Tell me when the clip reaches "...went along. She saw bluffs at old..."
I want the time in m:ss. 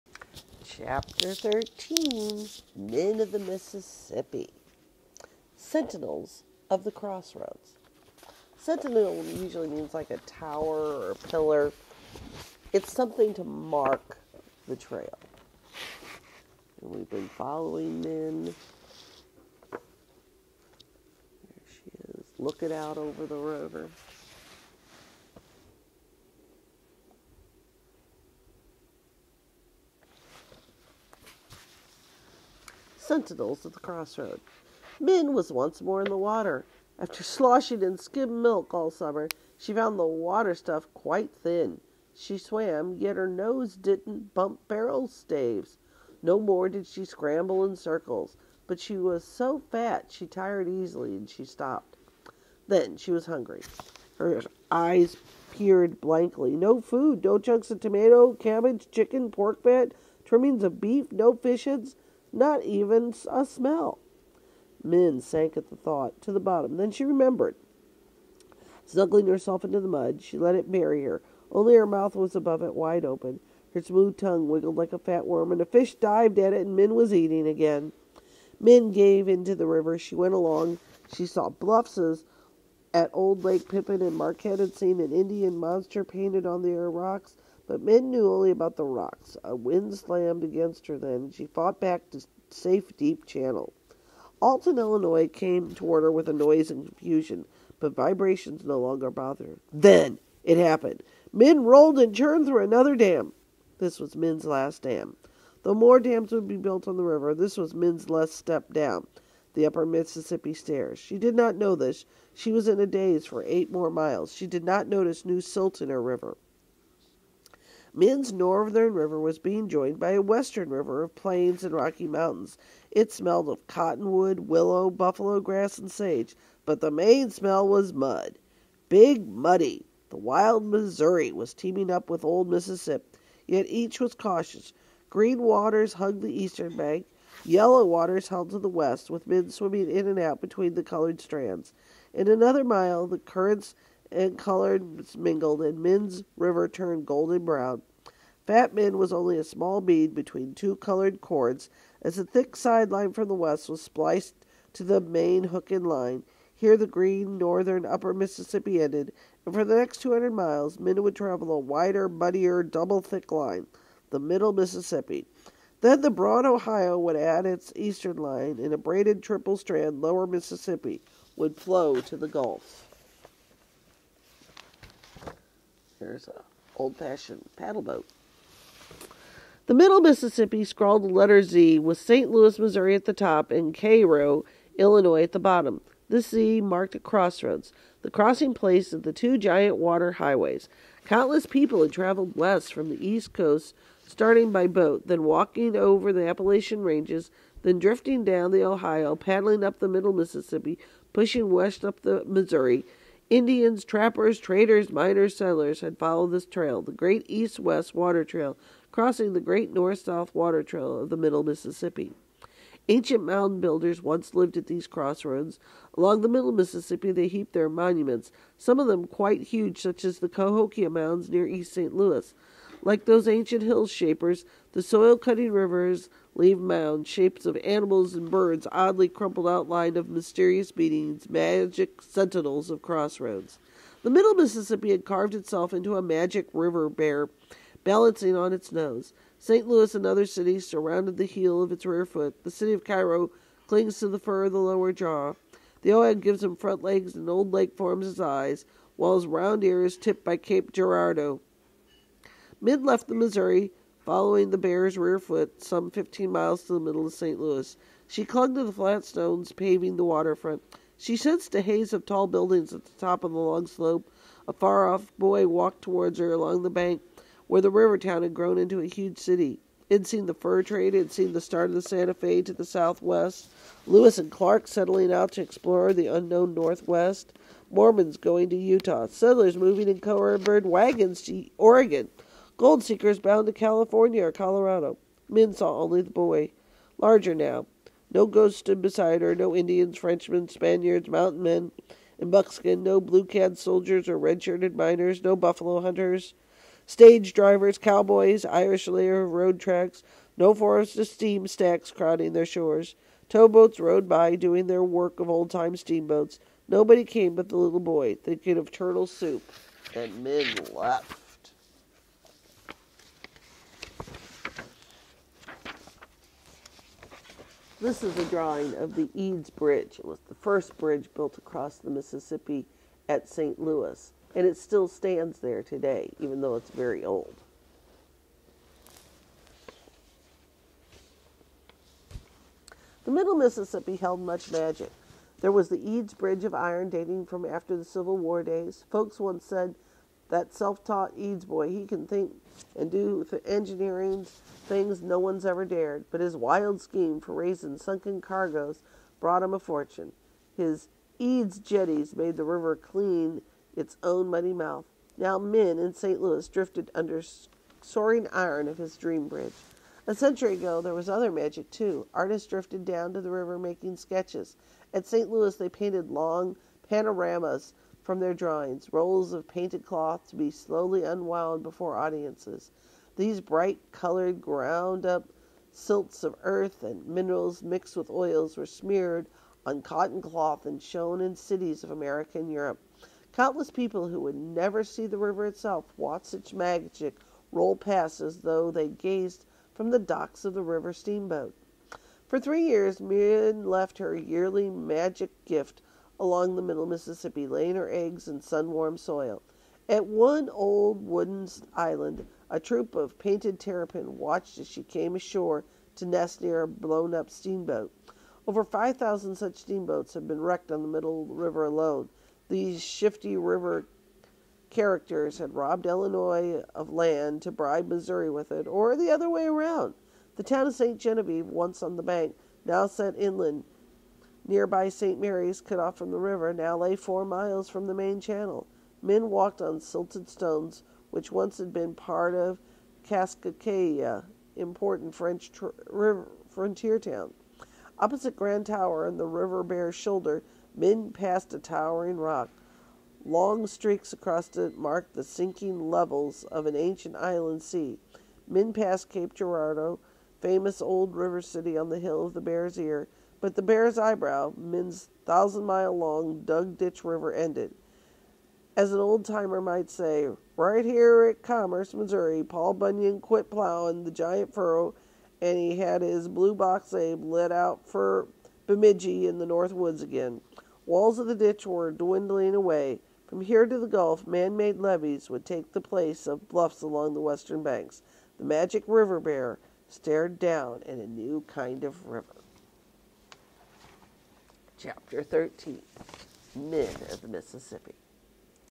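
1:20.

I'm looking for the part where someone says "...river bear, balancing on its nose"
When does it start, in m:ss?
3:56.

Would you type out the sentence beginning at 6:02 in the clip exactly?
Artists drifted down to the river making sketches.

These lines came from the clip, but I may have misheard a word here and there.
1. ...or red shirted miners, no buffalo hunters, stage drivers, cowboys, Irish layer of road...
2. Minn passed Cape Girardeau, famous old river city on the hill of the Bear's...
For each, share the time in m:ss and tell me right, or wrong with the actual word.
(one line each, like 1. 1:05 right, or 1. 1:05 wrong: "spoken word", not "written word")
1. 4:54 right
2. 7:28 right.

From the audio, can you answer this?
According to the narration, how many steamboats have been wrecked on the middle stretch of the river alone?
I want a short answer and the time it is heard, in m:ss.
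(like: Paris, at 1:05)
5,000, at 6:48.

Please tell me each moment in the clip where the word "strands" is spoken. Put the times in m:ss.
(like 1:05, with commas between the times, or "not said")
2:21, 2:49.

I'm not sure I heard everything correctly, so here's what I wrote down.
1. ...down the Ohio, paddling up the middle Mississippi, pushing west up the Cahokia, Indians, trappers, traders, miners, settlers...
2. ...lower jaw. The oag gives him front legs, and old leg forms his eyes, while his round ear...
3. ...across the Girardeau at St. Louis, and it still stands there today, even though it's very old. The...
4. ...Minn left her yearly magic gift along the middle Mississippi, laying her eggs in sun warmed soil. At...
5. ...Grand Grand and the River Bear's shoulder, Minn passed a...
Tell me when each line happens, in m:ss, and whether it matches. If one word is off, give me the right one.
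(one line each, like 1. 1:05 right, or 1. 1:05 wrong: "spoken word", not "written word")
1. 3:18 wrong: "Missouri", not "Cahokia"
2. 4:04 right
3. 5:21 wrong: "Mississippi", not "Girardeau"
4. 6:32 right
5. 7:18 wrong: "Tower", not "Grand".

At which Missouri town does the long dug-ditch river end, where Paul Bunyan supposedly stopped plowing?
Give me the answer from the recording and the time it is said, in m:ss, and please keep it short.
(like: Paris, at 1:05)
Commerce, at 7:41.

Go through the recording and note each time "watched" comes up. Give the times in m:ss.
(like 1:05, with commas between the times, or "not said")
6:25, 6:44.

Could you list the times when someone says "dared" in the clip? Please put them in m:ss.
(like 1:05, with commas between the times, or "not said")
5:45.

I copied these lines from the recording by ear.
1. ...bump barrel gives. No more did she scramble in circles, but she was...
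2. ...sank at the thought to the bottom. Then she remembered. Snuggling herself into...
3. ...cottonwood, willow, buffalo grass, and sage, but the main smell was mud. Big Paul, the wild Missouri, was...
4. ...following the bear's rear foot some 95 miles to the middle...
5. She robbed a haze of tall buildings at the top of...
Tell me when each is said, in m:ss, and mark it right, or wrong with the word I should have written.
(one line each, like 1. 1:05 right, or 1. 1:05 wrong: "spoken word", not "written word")
1. 0:44 wrong: "staves", not "gives"
2. 1:05 right
3. 2:03 wrong: "Muddy", not "Paul"
4. 4:14 wrong: "15", not "95"
5. 4:20 wrong: "sensed", not "robbed".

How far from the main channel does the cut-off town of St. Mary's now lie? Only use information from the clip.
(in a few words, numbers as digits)
4 miles.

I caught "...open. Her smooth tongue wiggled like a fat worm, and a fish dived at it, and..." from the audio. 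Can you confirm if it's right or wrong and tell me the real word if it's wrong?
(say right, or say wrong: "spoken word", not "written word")
right.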